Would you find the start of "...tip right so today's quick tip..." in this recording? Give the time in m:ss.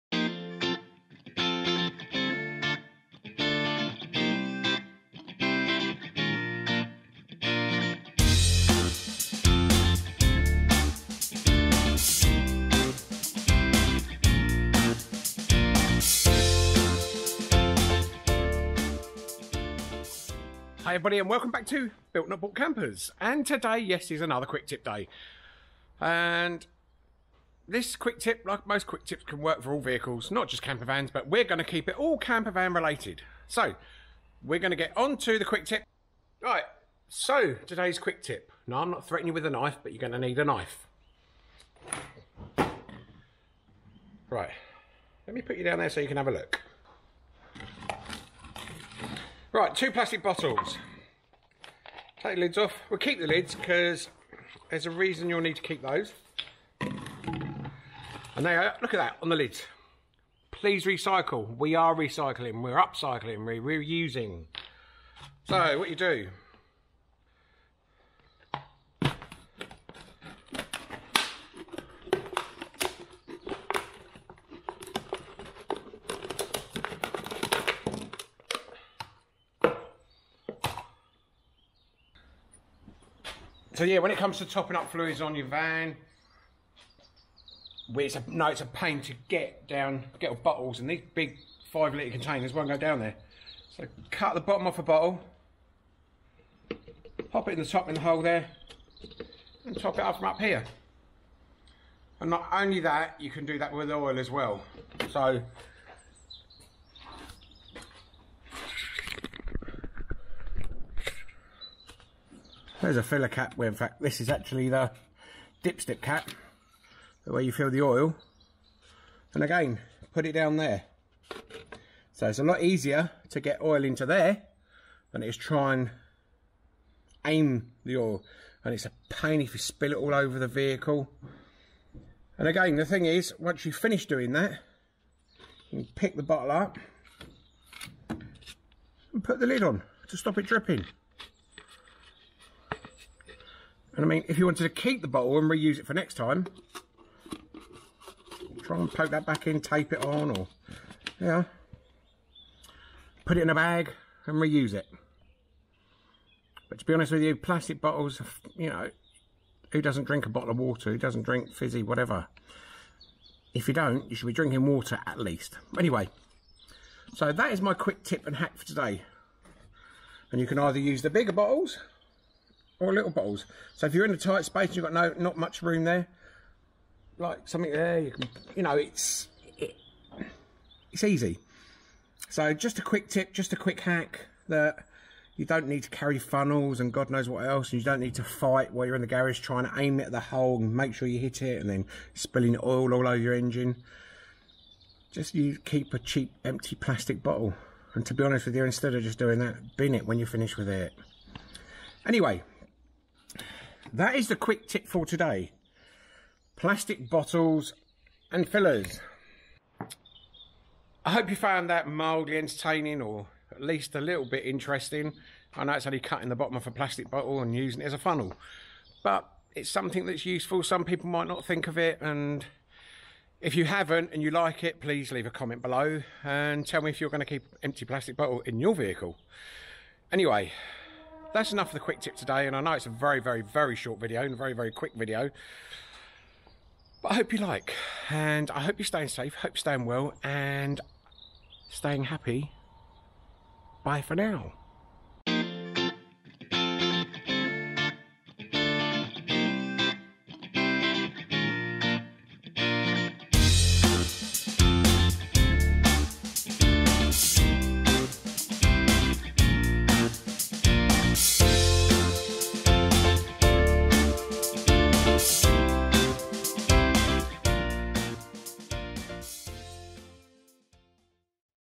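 0:35.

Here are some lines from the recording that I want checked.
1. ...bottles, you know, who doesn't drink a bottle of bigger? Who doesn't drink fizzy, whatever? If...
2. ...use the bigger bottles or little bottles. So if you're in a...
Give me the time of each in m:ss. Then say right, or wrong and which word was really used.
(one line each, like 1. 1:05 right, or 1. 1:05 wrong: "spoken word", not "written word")
1. 2:37 wrong: "water", not "bigger"
2. 2:50 right.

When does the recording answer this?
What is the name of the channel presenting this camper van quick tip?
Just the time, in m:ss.
0:22.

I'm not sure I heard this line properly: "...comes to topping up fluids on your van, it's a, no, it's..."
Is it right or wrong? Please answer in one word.
right.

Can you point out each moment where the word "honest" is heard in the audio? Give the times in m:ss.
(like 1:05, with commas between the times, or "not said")
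2:36, 3:18.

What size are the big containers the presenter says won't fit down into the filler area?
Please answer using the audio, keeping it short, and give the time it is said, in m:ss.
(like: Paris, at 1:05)
5 litres, at 1:31.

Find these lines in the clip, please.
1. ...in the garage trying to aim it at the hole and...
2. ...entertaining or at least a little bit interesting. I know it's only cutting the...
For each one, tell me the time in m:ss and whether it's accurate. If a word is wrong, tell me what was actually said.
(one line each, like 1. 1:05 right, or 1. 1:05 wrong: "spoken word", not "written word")
1. 3:08 right
2. 3:32 right.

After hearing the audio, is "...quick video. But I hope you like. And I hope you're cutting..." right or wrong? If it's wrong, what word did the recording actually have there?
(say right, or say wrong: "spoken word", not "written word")
wrong: "staying", not "cutting".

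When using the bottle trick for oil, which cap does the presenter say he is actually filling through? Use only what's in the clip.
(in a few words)
The dipstick cap.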